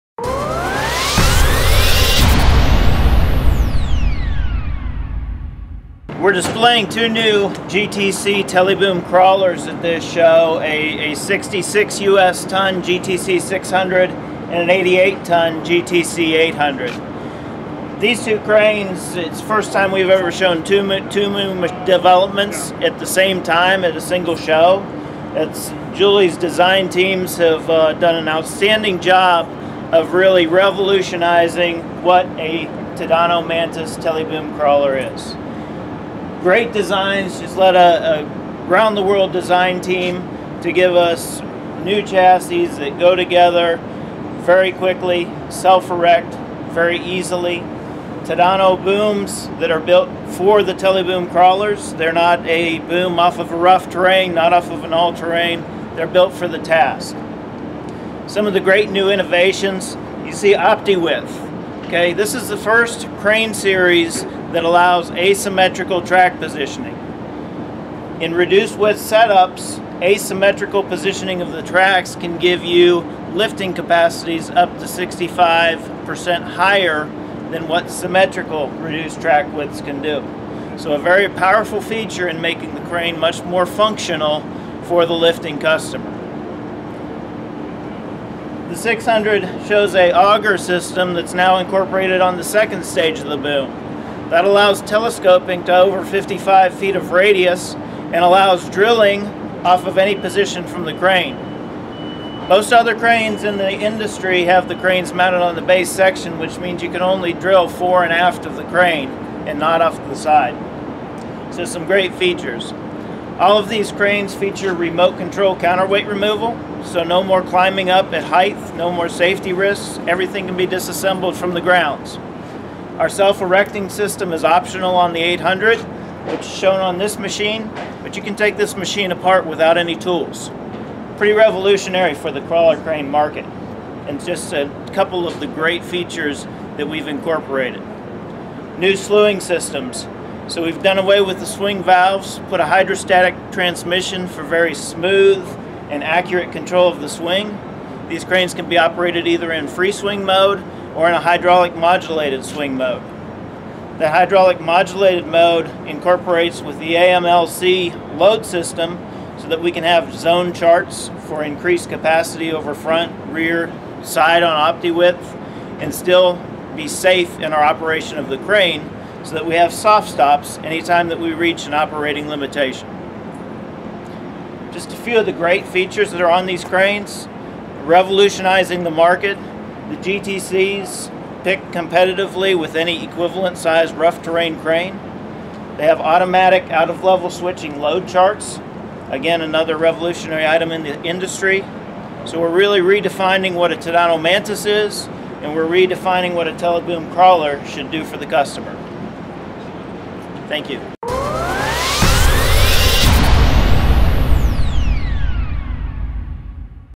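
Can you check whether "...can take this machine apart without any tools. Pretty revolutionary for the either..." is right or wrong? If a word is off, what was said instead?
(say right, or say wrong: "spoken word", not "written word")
wrong: "crawler", not "either".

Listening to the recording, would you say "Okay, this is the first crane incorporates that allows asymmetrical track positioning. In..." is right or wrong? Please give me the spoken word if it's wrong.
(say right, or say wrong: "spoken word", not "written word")
wrong: "series", not "incorporates".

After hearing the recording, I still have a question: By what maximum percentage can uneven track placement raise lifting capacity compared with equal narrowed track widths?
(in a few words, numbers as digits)
65%.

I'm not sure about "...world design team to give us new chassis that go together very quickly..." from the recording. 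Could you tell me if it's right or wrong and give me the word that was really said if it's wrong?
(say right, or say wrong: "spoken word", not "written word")
right.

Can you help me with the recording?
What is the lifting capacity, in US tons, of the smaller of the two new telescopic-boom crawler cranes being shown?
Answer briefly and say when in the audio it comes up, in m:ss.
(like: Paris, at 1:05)
66, at 0:11.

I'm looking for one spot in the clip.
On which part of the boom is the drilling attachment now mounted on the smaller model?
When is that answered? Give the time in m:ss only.
1:32.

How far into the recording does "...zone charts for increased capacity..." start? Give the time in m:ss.
2:40.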